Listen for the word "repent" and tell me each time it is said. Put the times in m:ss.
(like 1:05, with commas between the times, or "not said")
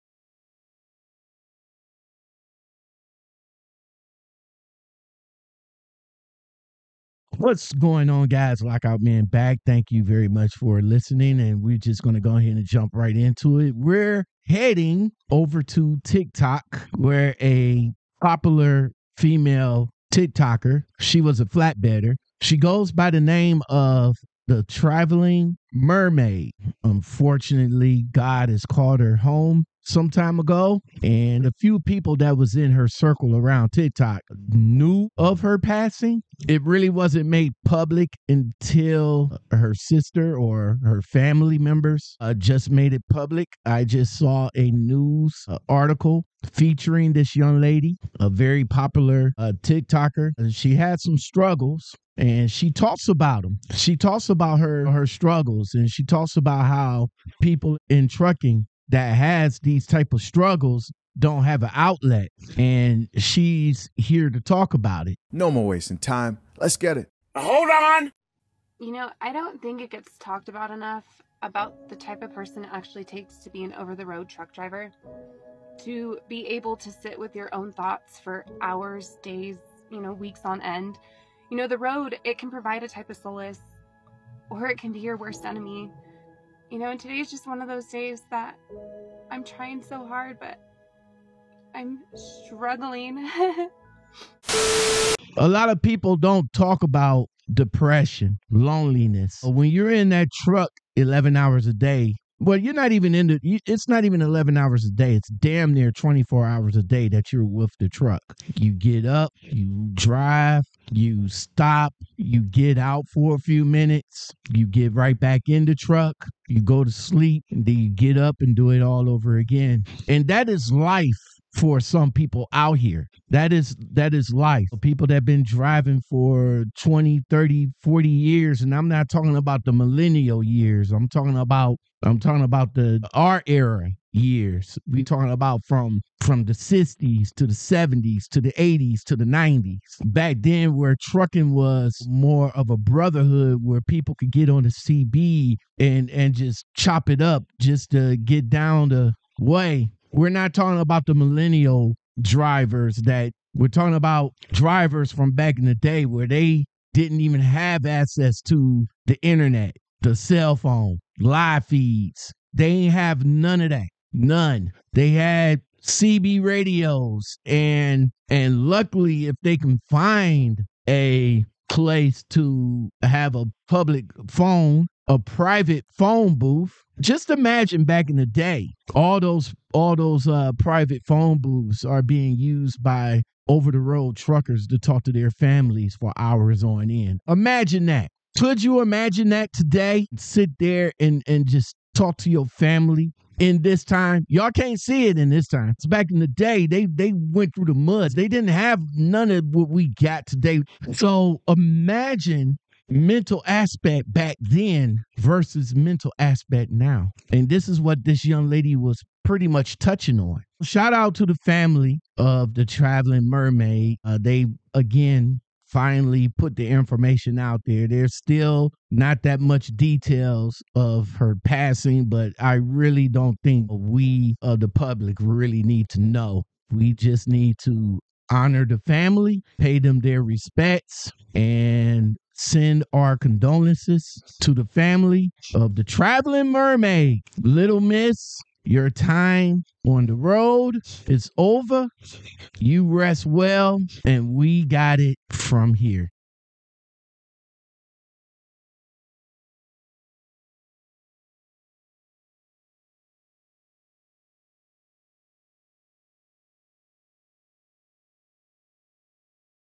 not said.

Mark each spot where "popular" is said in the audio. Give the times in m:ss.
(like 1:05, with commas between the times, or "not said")
0:18, 0:48.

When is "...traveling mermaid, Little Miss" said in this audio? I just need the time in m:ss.
3:55.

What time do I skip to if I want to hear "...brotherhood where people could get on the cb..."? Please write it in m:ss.
2:22.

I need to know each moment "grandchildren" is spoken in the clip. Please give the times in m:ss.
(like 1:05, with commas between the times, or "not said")
not said.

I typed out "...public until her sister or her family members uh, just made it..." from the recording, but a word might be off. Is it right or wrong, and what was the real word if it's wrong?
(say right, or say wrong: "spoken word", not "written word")
right.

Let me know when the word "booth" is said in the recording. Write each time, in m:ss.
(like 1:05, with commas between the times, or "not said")
2:56, 3:01.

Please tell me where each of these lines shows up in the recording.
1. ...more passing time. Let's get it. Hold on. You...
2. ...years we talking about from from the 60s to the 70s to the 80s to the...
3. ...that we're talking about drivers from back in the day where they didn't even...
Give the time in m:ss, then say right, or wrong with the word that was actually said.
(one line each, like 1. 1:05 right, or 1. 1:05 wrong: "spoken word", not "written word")
1. 1:05 wrong: "wasting", not "passing"
2. 2:14 right
3. 2:32 right.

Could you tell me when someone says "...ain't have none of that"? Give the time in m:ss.
2:42.